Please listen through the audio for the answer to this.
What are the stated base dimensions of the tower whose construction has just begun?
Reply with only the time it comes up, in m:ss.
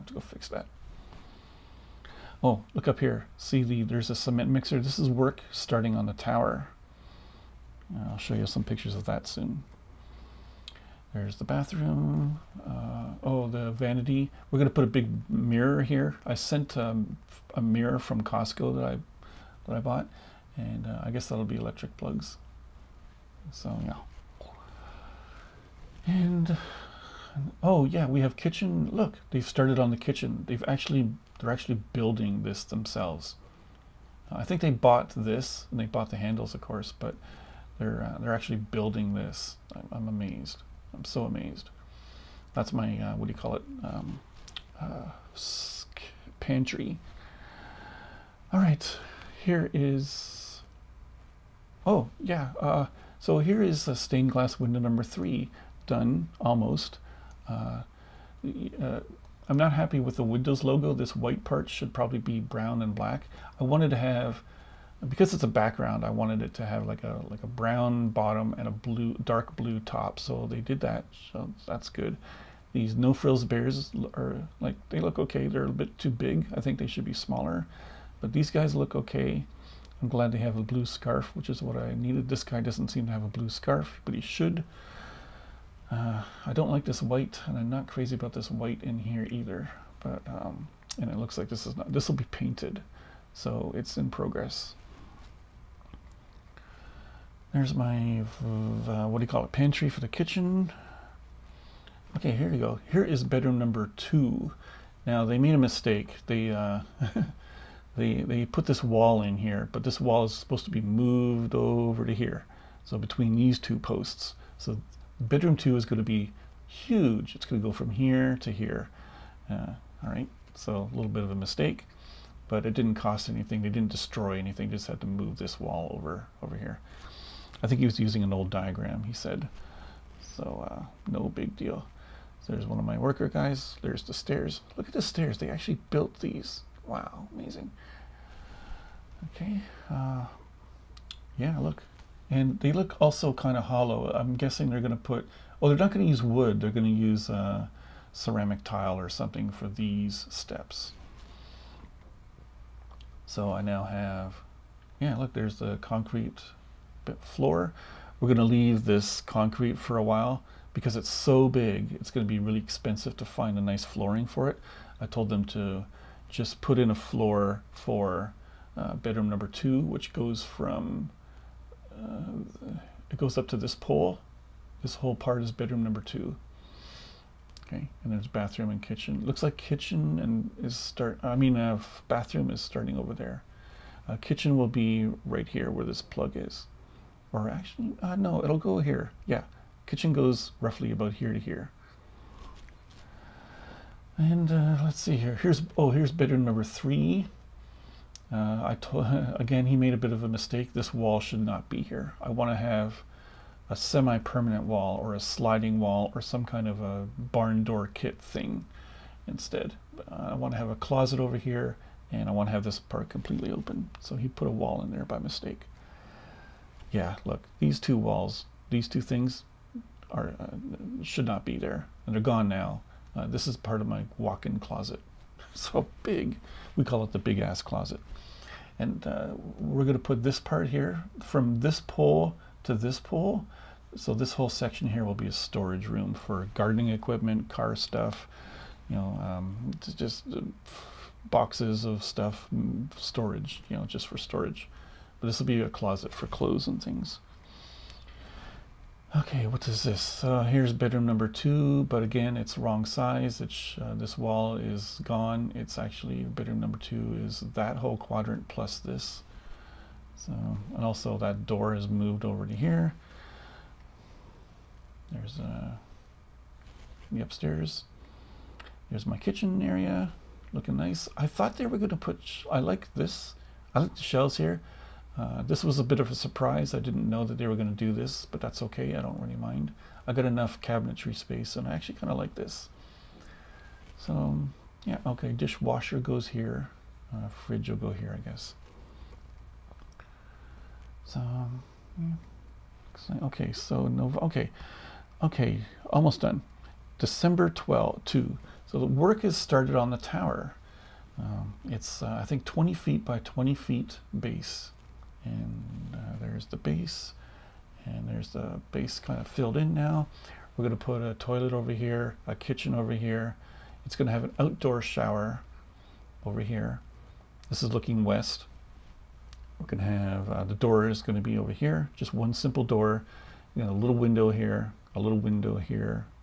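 5:02.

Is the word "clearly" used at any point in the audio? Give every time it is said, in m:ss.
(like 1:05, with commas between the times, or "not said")
not said.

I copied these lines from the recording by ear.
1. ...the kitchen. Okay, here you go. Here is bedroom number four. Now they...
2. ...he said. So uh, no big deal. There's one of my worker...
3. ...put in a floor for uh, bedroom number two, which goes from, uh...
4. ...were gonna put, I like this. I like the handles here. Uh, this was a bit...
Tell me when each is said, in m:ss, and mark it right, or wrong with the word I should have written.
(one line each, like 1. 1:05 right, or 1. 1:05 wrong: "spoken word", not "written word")
1. 1:40 wrong: "two", not "four"
2. 2:09 right
3. 2:46 right
4. 4:31 wrong: "shelves", not "handles".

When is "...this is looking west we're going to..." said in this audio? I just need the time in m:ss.
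5:17.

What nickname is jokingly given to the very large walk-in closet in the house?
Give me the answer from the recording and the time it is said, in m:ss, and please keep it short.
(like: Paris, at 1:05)
The big ass closet, at 3:47.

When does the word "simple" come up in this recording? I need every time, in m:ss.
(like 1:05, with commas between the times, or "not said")
5:22.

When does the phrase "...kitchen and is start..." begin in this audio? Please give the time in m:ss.
2:59.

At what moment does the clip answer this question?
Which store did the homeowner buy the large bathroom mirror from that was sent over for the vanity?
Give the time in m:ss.
0:18.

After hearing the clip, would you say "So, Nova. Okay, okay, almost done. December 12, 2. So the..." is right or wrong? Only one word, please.
right.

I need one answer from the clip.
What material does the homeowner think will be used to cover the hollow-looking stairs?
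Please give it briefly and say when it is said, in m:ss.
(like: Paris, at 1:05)
Ceramic tile, at 2:28.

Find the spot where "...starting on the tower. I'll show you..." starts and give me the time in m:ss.
0:05.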